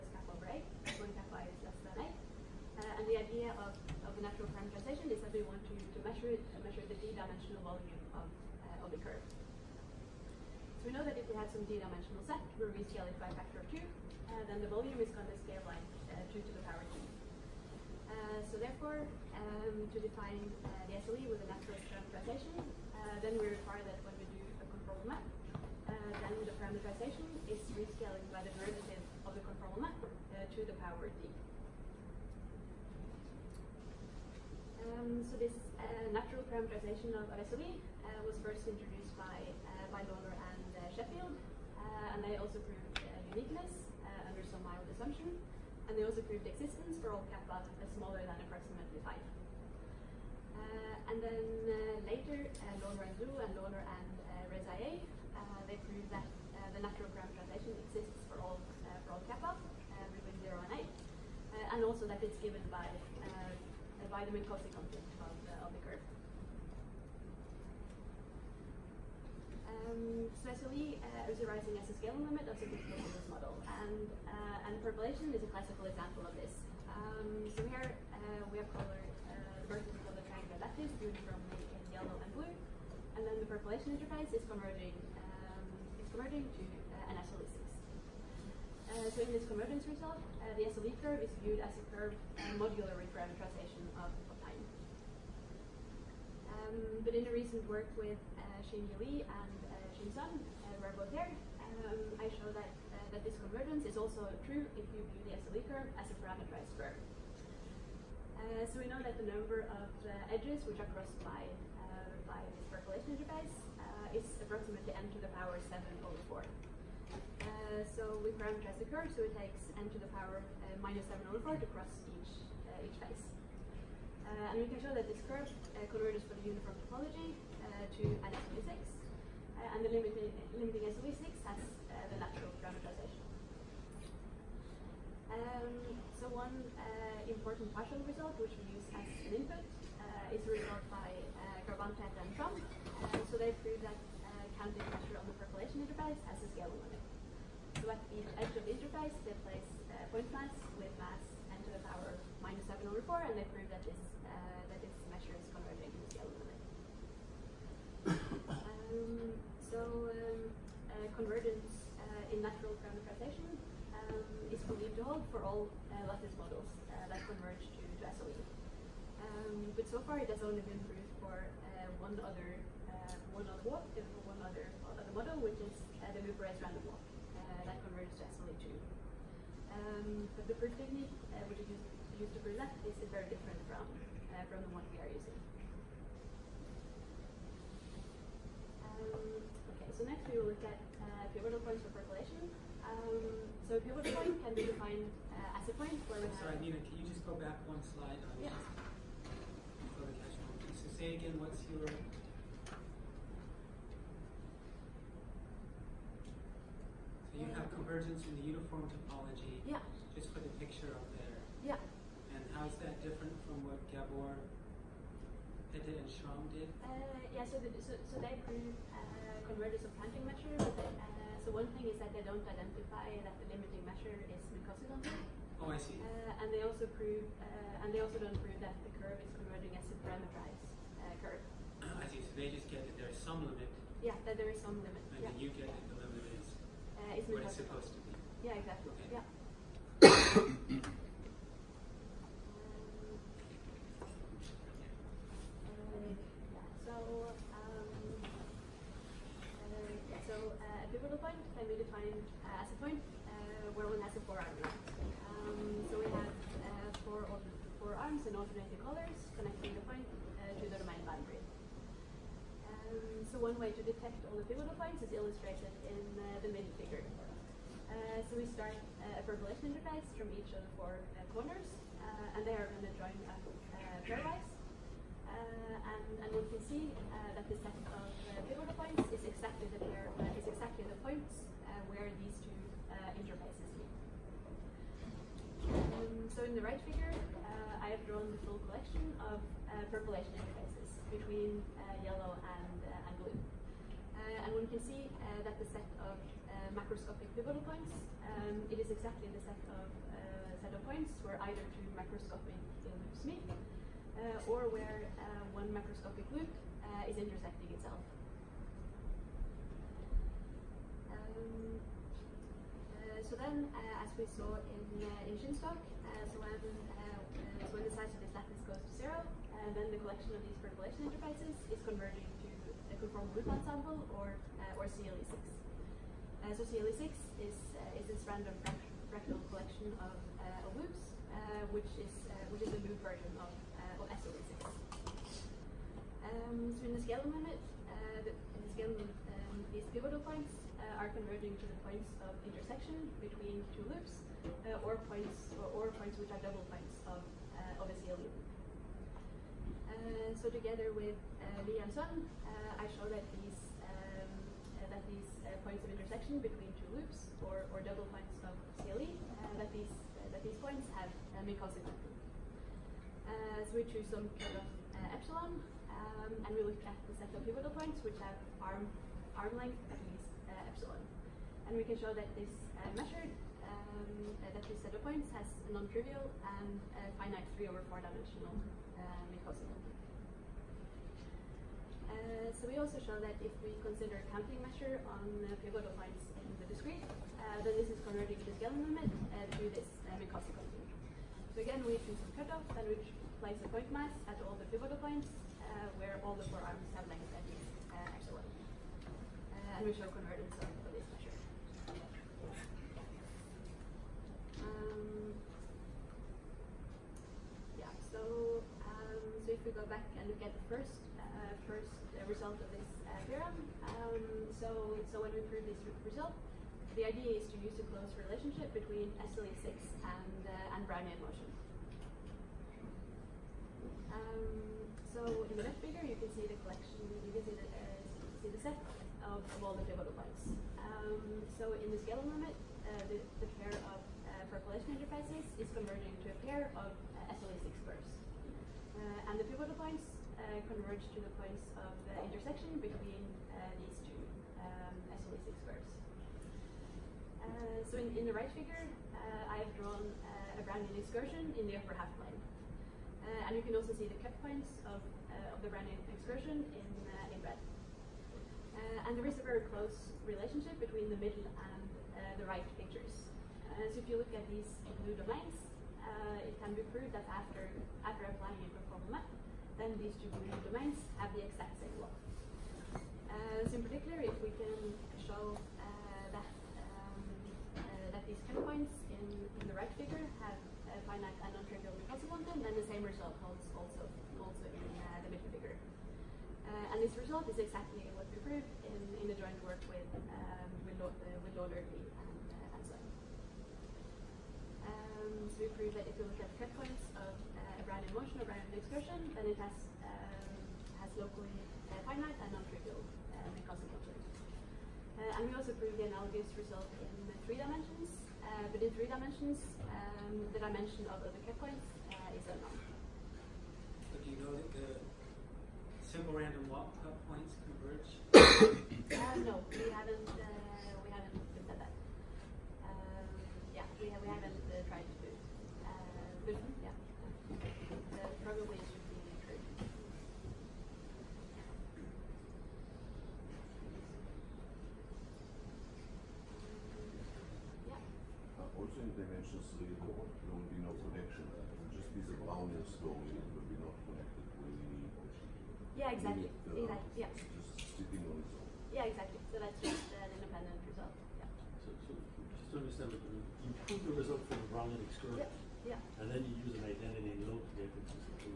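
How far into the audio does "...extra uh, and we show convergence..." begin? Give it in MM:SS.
06:38.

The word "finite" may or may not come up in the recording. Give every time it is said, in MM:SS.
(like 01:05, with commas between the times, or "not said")
06:17, 08:01, 08:22.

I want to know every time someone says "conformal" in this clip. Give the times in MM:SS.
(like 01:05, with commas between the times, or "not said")
05:23, 07:48.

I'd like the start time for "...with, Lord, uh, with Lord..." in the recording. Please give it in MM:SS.
08:10.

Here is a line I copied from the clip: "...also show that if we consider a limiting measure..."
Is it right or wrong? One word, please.
wrong.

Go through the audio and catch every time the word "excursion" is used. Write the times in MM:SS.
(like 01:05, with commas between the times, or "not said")
07:30, 07:36.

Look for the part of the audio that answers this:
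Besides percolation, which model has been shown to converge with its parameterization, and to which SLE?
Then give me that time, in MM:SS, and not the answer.
02:56.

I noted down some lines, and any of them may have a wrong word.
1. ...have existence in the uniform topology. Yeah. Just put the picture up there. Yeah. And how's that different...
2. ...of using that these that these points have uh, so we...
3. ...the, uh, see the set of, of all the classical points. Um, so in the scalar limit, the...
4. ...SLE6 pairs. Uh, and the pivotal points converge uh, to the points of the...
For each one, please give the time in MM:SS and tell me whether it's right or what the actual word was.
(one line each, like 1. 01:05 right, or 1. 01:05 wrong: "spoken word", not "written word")
1. 03:27 wrong: "convergence", not "existence"
2. 05:58 wrong: "scaling", not "using"
3. 07:07 wrong: "pivotal", not "classical"
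4. 07:17 right.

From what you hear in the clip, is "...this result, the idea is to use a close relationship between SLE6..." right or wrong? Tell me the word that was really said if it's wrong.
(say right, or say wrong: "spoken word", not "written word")
right.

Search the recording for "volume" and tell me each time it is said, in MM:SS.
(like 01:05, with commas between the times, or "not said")
00:07, 00:14.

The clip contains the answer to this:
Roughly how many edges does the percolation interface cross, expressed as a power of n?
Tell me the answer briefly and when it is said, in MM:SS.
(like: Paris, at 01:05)
n to the 7/4, at 01:54.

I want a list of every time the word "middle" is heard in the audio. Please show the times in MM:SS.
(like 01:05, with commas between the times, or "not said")
04:26, 07:41, 08:05.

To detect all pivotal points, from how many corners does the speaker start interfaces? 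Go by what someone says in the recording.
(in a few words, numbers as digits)
4.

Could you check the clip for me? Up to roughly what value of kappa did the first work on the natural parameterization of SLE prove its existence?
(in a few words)
approximately 5.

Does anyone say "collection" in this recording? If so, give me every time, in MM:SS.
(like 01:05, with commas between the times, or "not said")
04:48, 05:19, 05:29, 07:06.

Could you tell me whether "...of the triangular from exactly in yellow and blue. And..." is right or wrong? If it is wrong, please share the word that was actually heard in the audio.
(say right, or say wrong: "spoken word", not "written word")
wrong: "uniformly", not "exactly".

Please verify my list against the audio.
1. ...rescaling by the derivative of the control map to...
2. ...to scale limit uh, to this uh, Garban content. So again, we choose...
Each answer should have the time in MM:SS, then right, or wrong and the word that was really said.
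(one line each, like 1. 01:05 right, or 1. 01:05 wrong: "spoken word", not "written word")
1. 00:27 right
2. 06:28 wrong: "Minkowski", not "Garban".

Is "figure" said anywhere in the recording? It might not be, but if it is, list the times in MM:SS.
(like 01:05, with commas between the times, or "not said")
04:26, 04:46, 07:05, 07:28, 07:59, 08:05.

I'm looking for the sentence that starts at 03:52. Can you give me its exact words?
So they just get that there is some limit.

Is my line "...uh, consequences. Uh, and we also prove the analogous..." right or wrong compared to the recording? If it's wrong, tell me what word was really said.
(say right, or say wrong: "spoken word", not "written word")
right.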